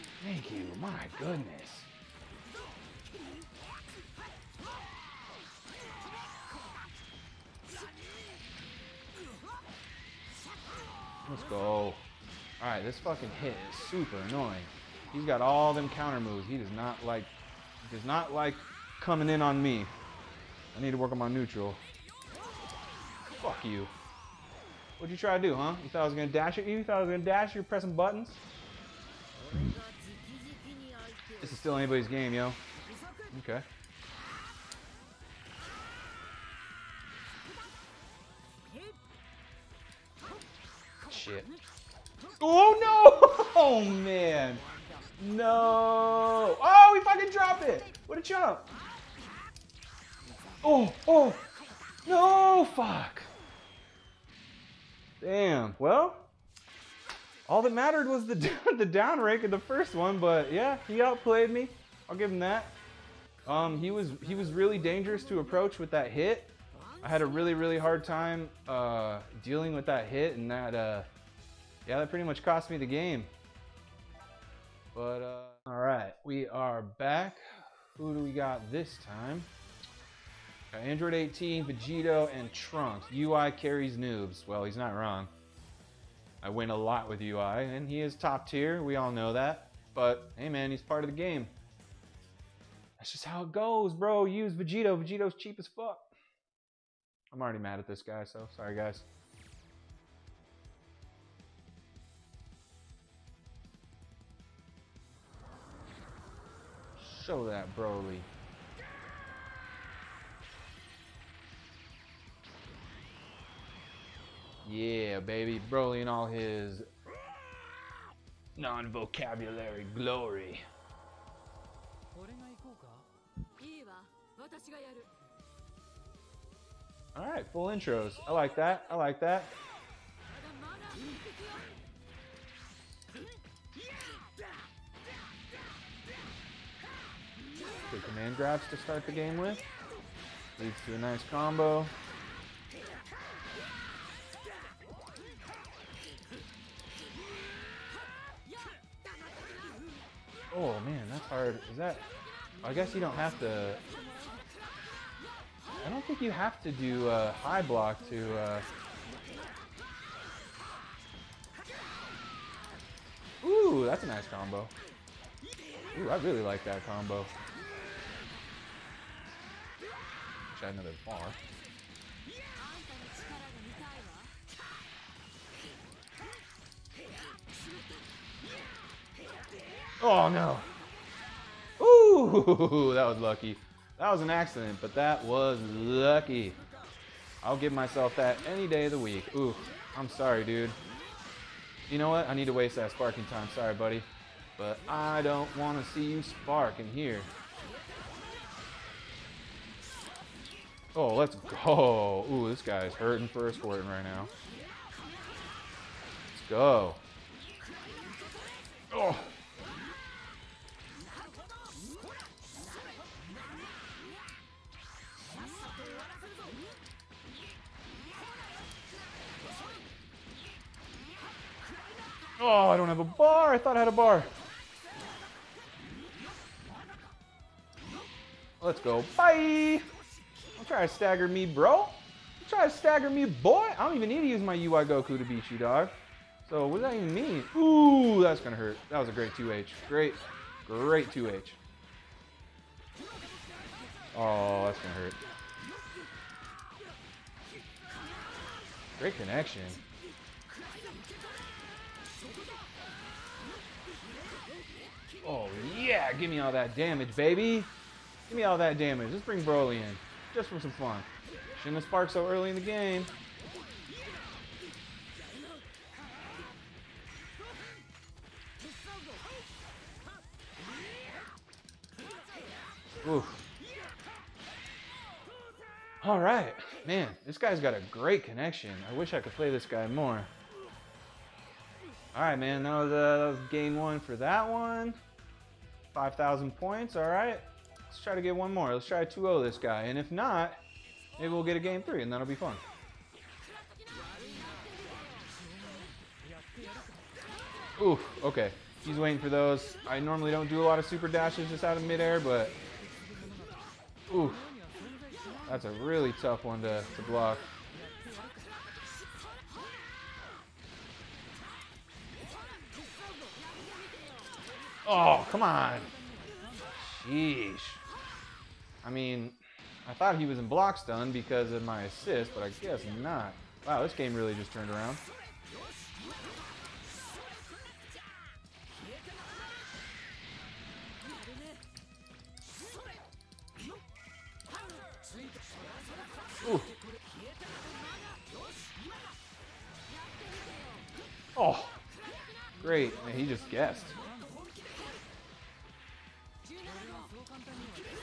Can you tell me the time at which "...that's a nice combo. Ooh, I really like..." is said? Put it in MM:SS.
02:43.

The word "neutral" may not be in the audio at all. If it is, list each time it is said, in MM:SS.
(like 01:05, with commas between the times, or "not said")
00:21.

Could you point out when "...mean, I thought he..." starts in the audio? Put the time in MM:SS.
05:18.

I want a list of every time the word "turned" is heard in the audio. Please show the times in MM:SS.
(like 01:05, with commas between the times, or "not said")
05:24.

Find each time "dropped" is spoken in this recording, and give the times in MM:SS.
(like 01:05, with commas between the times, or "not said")
00:47.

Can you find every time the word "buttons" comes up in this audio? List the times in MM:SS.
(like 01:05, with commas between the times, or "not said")
00:27.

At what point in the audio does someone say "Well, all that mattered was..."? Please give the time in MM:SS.
00:55.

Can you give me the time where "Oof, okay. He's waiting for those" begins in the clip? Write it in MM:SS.
04:57.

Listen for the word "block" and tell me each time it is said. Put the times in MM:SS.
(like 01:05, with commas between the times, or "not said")
02:37, 05:07, 05:20.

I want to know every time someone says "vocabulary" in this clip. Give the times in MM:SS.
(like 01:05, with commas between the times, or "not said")
01:58.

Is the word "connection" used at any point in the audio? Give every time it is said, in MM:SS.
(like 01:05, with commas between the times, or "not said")
04:09, 04:38.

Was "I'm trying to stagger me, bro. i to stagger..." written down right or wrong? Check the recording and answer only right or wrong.
right.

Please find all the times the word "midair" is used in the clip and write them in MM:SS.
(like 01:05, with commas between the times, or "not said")
05:01.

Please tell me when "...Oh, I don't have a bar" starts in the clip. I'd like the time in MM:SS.
03:42.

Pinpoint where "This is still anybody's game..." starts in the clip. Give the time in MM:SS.
00:31.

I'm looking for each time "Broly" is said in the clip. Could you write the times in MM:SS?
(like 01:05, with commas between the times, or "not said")
01:47, 01:55, 04:19.